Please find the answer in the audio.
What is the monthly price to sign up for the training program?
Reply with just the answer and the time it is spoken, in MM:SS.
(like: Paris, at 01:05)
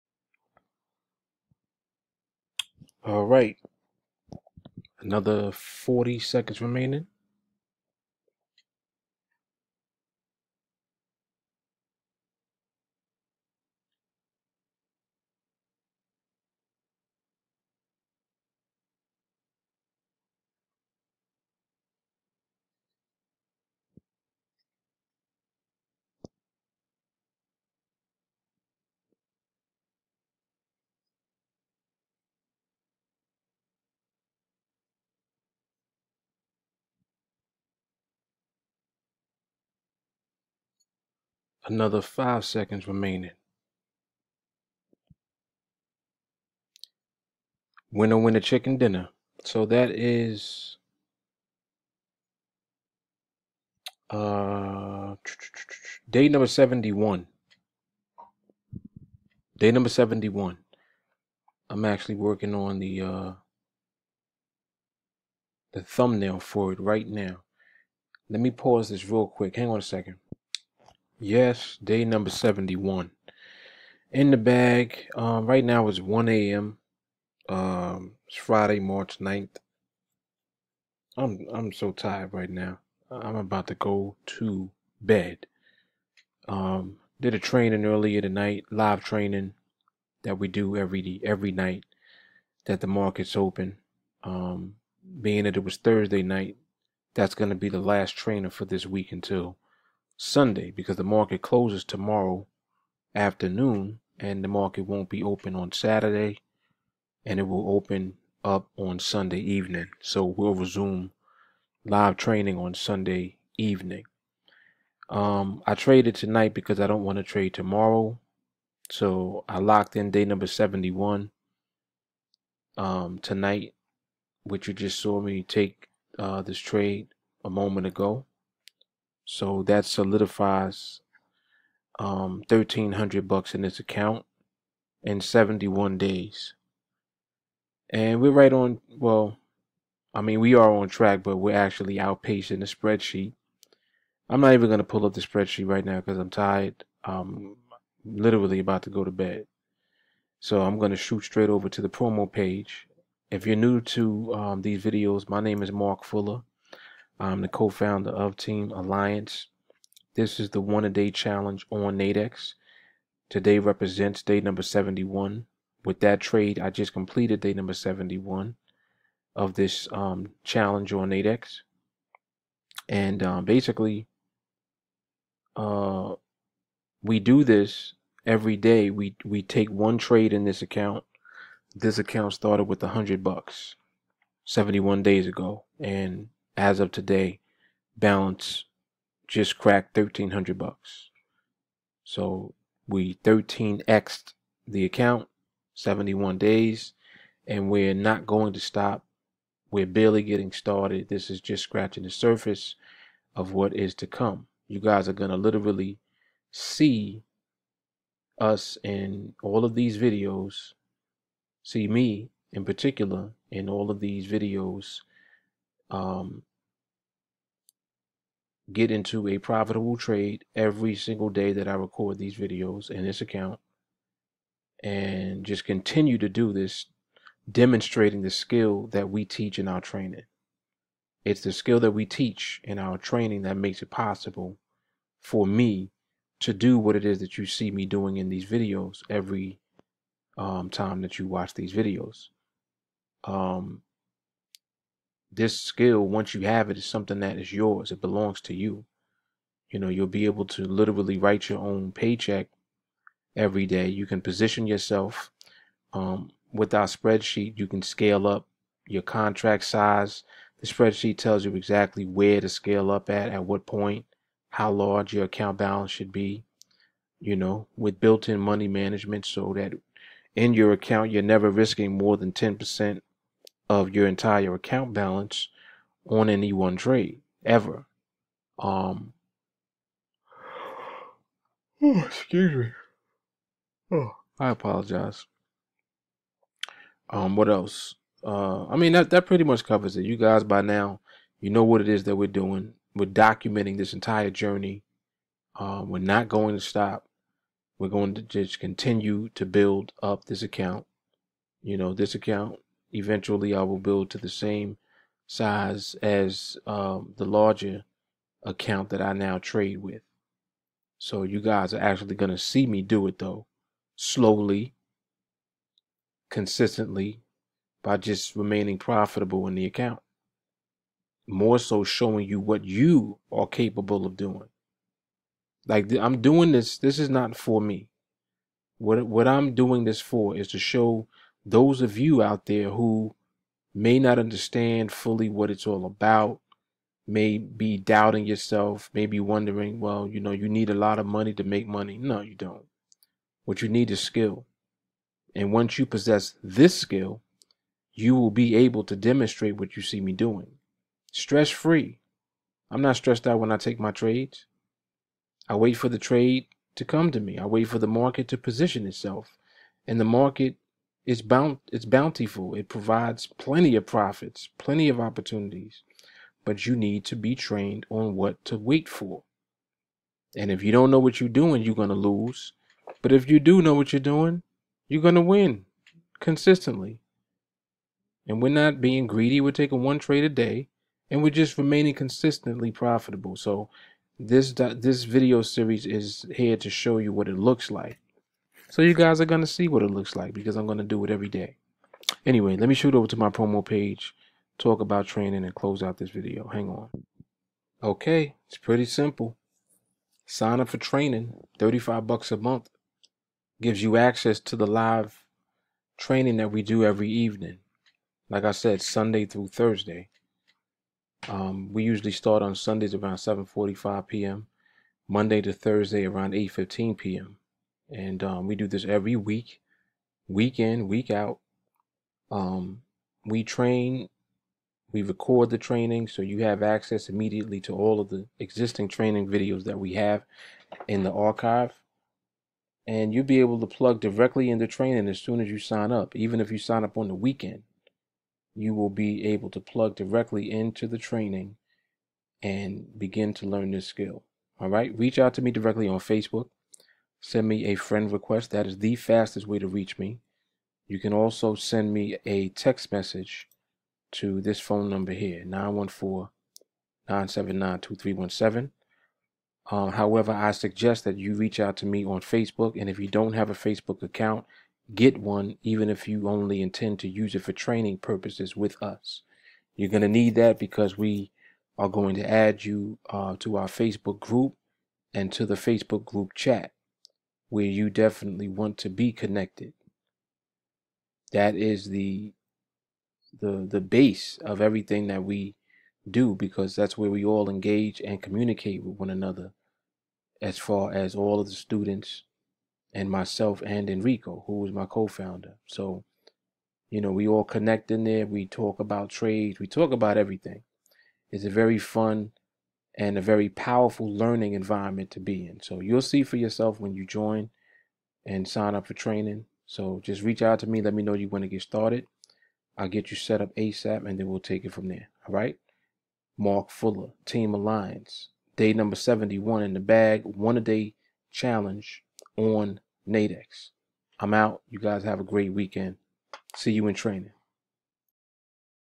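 $35, at 06:41.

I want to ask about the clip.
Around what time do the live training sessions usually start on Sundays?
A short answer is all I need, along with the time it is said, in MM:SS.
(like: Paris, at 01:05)
7:45 p.m., at 06:53.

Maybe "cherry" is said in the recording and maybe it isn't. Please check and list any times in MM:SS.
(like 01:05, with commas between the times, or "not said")
not said.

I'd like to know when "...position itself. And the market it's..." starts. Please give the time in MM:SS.
05:58.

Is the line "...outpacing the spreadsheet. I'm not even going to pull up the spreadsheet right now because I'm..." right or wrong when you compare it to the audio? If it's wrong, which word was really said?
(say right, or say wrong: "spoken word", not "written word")
right.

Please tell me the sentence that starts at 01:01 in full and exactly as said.
I'm actually working on the uh, the thumbnail for it right now.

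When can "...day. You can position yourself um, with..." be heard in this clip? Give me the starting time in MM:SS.
04:13.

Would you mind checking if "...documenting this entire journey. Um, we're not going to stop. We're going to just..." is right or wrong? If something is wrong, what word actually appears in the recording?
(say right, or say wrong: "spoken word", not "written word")
right.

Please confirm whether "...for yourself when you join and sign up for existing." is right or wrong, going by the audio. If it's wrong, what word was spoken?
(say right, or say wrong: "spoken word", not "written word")
wrong: "training", not "existing".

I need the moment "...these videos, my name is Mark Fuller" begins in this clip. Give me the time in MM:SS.
02:34.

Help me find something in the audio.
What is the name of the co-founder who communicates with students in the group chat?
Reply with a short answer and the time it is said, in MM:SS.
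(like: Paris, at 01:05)
Enrico, at 08:13.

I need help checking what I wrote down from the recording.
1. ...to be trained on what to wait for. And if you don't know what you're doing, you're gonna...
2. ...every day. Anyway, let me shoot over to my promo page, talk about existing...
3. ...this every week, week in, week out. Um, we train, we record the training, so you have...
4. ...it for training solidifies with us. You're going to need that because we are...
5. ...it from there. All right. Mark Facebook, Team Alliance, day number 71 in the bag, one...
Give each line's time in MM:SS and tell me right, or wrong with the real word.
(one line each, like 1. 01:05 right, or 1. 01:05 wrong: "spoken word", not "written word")
1. 06:07 right
2. 06:31 wrong: "training", not "existing"
3. 06:58 right
4. 07:47 wrong: "purposes", not "solidifies"
5. 08:34 wrong: "Fuller", not "Facebook".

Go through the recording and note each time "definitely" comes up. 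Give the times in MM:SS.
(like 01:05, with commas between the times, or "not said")
07:57.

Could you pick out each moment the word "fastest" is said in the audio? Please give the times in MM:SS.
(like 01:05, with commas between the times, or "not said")
07:28.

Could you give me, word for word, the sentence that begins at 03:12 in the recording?
So we 13xed the account, 71 days, and we're not going to stop.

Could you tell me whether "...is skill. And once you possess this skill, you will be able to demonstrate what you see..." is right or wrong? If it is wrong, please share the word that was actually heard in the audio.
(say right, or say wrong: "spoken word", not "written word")
right.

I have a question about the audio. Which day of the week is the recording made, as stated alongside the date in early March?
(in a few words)
Friday.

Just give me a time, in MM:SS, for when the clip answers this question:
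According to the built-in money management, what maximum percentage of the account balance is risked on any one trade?
04:32.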